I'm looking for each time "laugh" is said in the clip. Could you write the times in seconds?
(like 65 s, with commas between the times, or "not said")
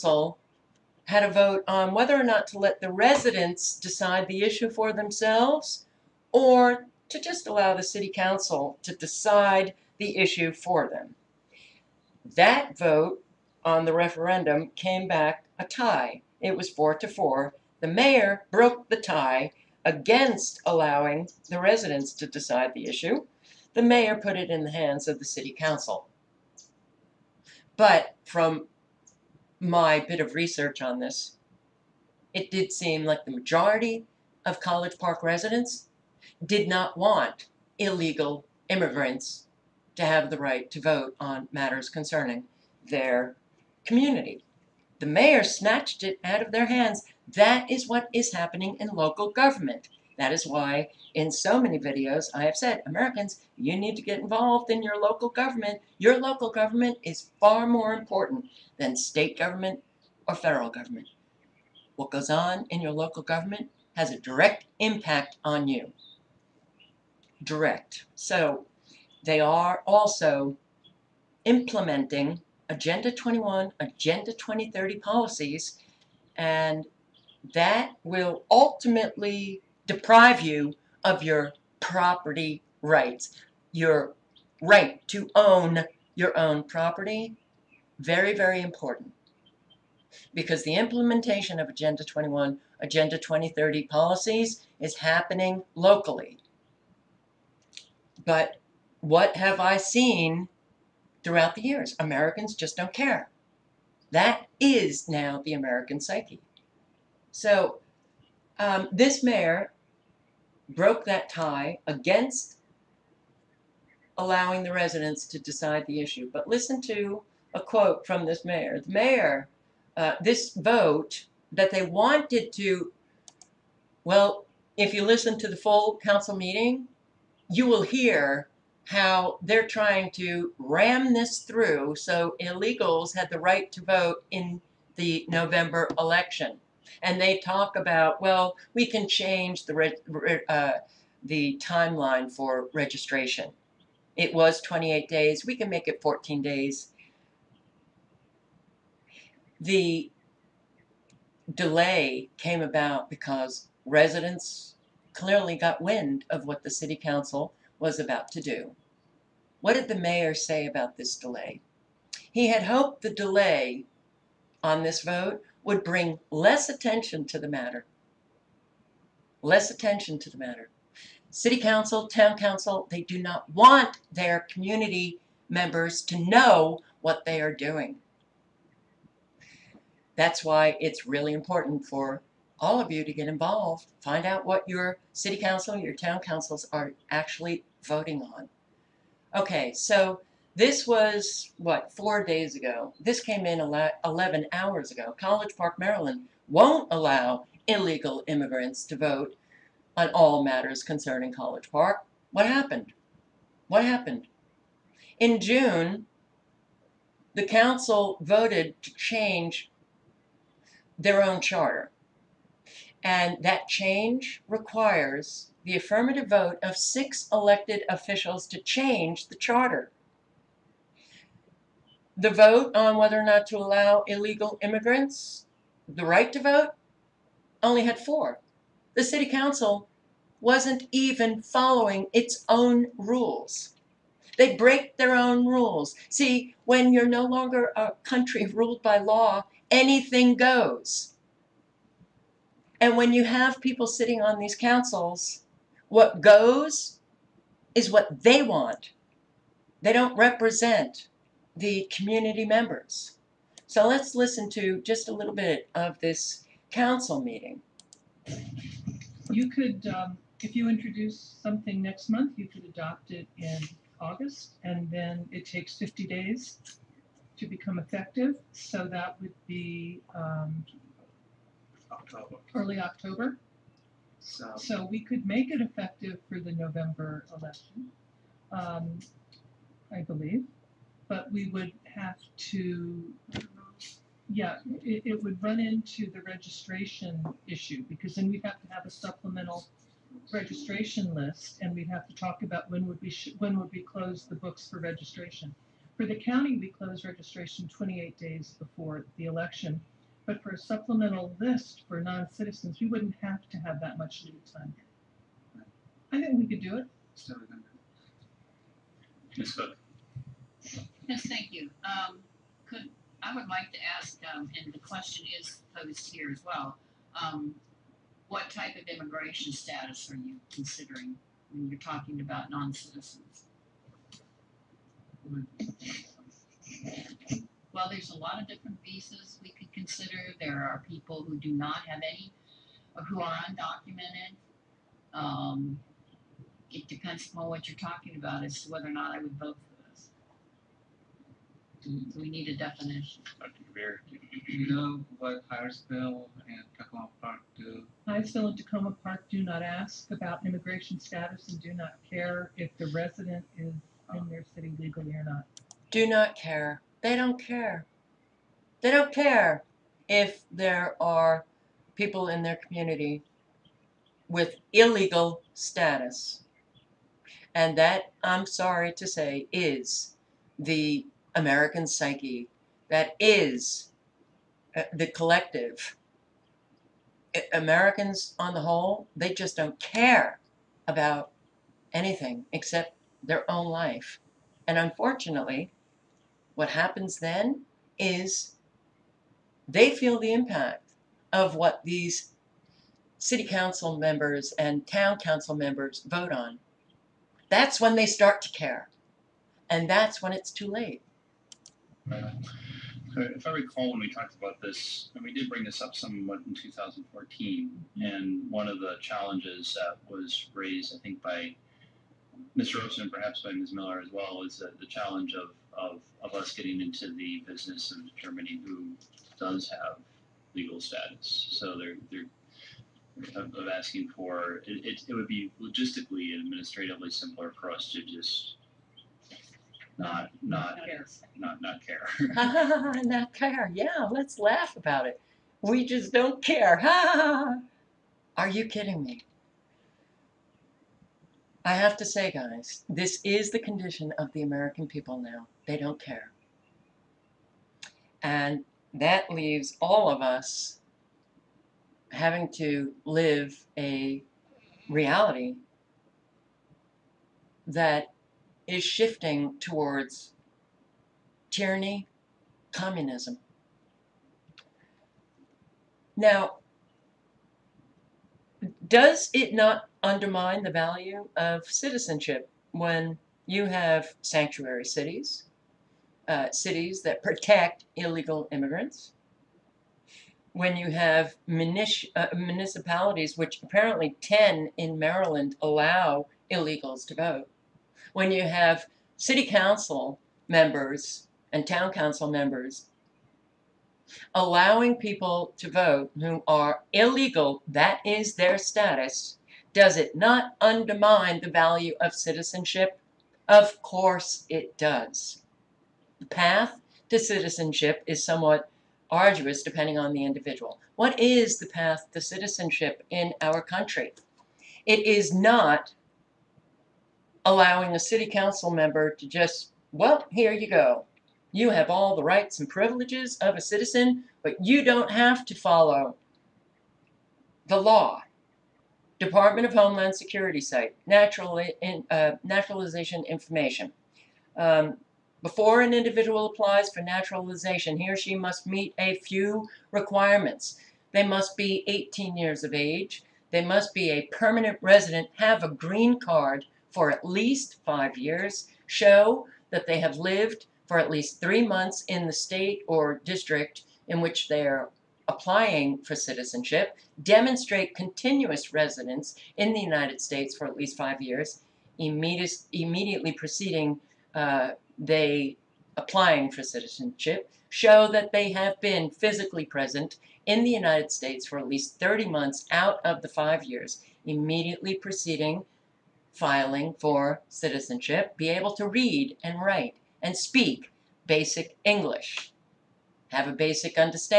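434 s.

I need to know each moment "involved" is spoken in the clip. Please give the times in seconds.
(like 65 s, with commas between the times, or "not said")
54 s, 183 s.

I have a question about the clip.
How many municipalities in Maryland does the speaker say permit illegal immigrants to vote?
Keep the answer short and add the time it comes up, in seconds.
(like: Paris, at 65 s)
10, at 484 s.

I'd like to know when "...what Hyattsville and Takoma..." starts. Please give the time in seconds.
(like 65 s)
345 s.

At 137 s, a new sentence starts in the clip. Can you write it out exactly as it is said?
And they talk about, well, we can change the, uh, the timeline for registration.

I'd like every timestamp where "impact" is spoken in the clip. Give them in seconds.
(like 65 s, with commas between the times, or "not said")
64 s, 390 s.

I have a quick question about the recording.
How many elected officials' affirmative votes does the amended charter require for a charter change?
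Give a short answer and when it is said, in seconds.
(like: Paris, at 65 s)
6, at 216 s.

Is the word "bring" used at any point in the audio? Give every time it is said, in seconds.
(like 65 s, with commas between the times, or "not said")
165 s, 405 s.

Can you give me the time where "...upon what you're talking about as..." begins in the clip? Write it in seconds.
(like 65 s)
337 s.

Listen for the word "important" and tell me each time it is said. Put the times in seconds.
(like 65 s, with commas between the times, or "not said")
57 s, 88 s, 181 s.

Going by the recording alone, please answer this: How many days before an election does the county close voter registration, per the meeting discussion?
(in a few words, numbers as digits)
28.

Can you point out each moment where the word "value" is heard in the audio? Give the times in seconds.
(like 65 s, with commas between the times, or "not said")
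470 s, 501 s.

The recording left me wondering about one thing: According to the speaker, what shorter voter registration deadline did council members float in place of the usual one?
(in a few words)
14 days.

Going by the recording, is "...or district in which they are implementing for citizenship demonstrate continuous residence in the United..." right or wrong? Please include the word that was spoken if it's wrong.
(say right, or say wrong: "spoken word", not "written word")
wrong: "applying", not "implementing".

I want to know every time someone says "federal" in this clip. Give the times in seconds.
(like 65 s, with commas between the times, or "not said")
60 s.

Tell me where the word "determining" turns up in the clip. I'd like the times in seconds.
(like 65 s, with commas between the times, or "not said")
418 s.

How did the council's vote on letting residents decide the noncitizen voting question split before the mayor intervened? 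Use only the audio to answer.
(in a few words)
4 to 4.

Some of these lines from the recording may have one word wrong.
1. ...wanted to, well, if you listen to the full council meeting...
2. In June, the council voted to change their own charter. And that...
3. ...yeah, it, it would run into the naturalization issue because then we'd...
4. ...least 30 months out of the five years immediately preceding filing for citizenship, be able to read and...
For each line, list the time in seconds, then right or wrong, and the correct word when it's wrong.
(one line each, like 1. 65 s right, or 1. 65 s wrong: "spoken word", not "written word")
1. 121 s right
2. 205 s right
3. 284 s wrong: "registration", not "naturalization"
4. 571 s right.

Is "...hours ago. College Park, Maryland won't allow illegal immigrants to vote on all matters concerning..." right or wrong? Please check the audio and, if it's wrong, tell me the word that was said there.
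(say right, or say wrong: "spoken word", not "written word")
right.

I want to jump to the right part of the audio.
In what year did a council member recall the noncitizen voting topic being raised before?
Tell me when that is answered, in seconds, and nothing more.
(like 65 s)
406 s.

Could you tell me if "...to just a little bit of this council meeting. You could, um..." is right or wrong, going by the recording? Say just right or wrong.
right.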